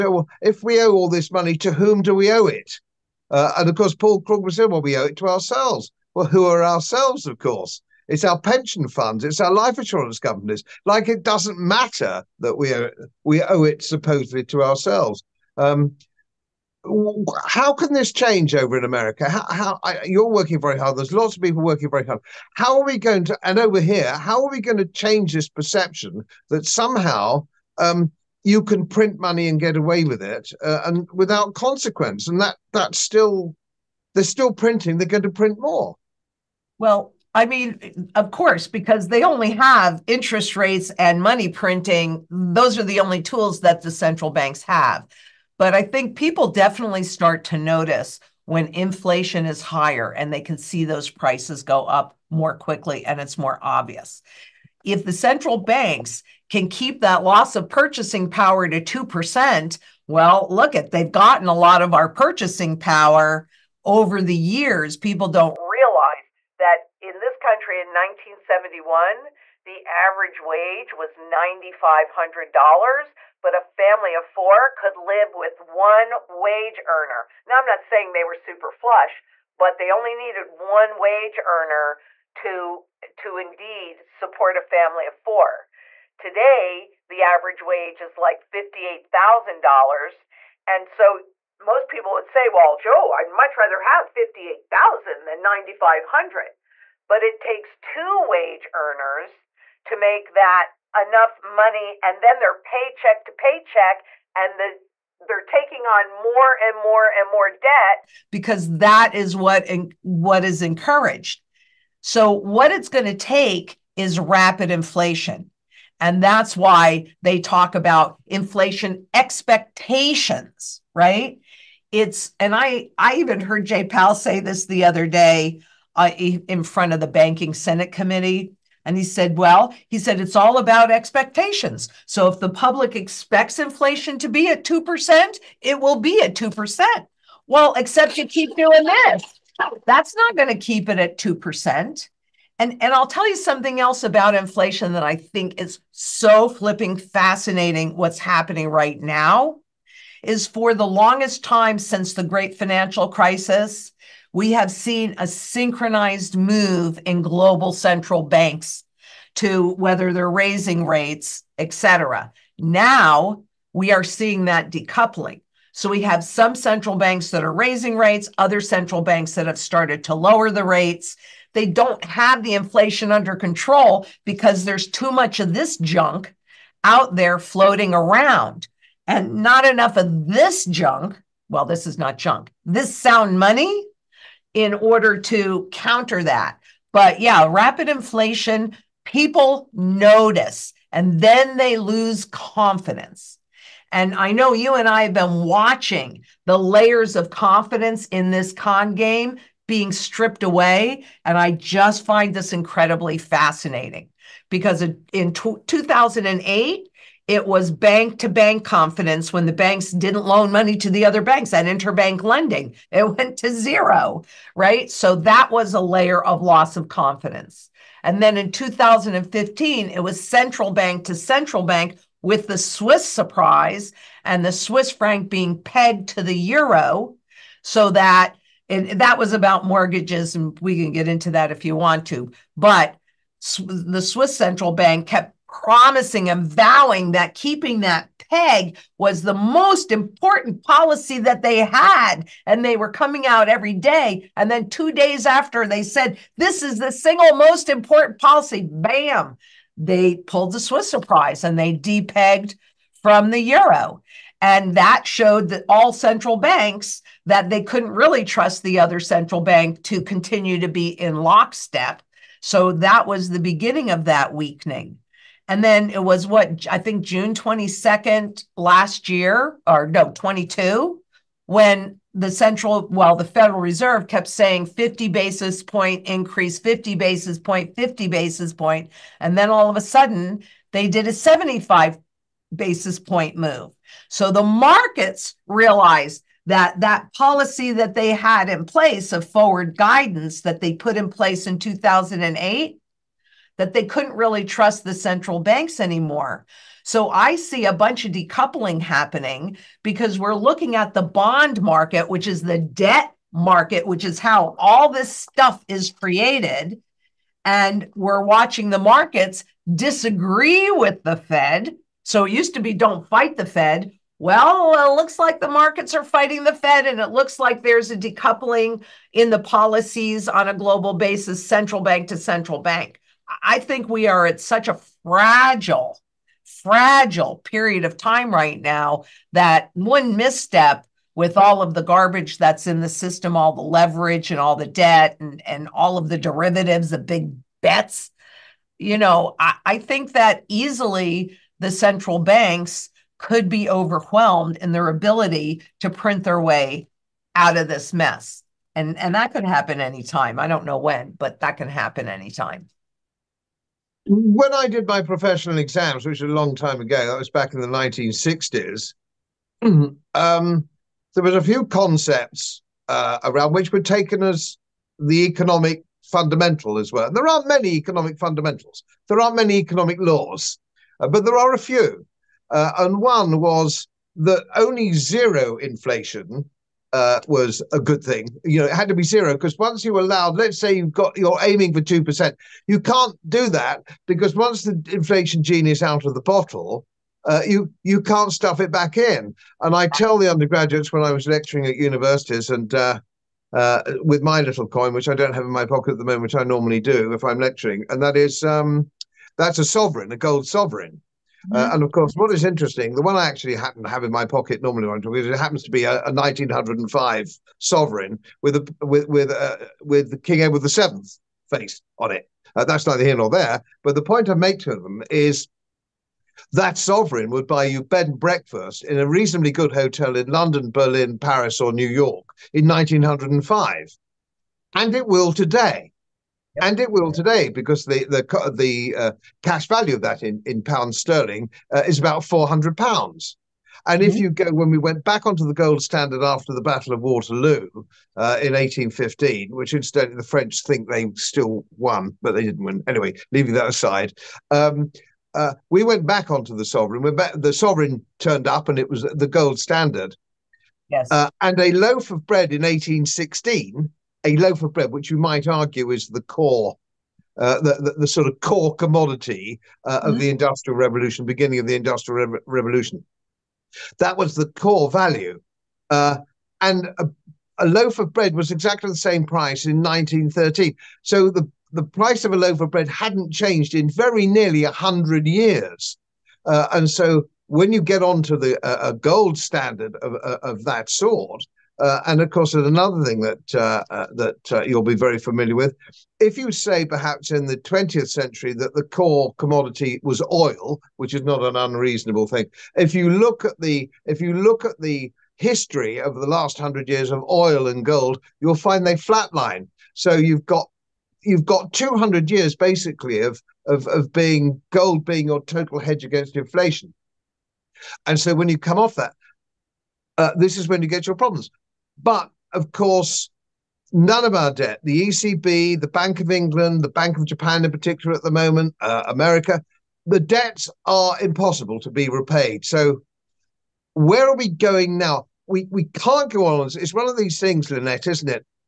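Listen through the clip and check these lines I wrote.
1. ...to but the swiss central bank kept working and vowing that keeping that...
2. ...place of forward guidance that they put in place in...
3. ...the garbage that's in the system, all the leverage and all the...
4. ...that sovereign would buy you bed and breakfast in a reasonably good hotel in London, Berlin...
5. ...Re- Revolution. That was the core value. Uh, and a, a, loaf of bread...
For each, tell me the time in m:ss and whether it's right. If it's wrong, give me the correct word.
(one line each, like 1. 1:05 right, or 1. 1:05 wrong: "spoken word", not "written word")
1. 3:52 wrong: "promising", not "working"
2. 4:48 right
3. 5:31 right
4. 6:56 right
5. 7:42 right.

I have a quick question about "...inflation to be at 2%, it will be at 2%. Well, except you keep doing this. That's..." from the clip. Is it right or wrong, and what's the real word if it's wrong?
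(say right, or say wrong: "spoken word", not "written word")
right.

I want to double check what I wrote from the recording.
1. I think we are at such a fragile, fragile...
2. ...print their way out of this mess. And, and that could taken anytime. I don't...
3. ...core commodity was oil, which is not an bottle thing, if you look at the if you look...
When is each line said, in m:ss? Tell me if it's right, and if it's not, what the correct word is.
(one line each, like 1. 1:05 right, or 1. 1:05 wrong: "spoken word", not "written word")
1. 5:23 right
2. 5:45 wrong: "happen", not "taken"
3. 8:08 wrong: "unreasonable", not "bottle".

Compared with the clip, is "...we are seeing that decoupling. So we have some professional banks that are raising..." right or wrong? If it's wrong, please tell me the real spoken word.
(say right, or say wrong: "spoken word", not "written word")
wrong: "central", not "professional".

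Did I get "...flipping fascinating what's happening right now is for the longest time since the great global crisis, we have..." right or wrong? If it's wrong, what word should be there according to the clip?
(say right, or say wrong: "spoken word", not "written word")
wrong: "financial", not "global".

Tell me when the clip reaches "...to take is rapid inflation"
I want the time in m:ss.
1:53.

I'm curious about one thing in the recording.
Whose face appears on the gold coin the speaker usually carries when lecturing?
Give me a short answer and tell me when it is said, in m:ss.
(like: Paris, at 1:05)
King Edward the Seventh, at 6:50.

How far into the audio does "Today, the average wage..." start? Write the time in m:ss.
1:26.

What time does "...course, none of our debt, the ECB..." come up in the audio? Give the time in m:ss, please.
8:32.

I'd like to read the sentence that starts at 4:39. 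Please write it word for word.
And then all of a sudden, they did a 75 basis point move.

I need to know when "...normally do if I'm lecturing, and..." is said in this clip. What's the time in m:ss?
6:36.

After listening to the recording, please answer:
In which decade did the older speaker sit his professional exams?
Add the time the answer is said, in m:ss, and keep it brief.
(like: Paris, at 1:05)
1960s, at 5:57.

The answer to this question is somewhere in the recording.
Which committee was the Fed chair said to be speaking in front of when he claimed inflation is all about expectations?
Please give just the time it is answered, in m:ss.
2:07.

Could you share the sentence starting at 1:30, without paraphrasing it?
And so most people would say, well, Joe, I'd much rather have 58,000 than 9,500.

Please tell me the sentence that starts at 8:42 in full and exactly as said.
So where are we going now?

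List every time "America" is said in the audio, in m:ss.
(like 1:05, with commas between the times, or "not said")
0:18, 8:39.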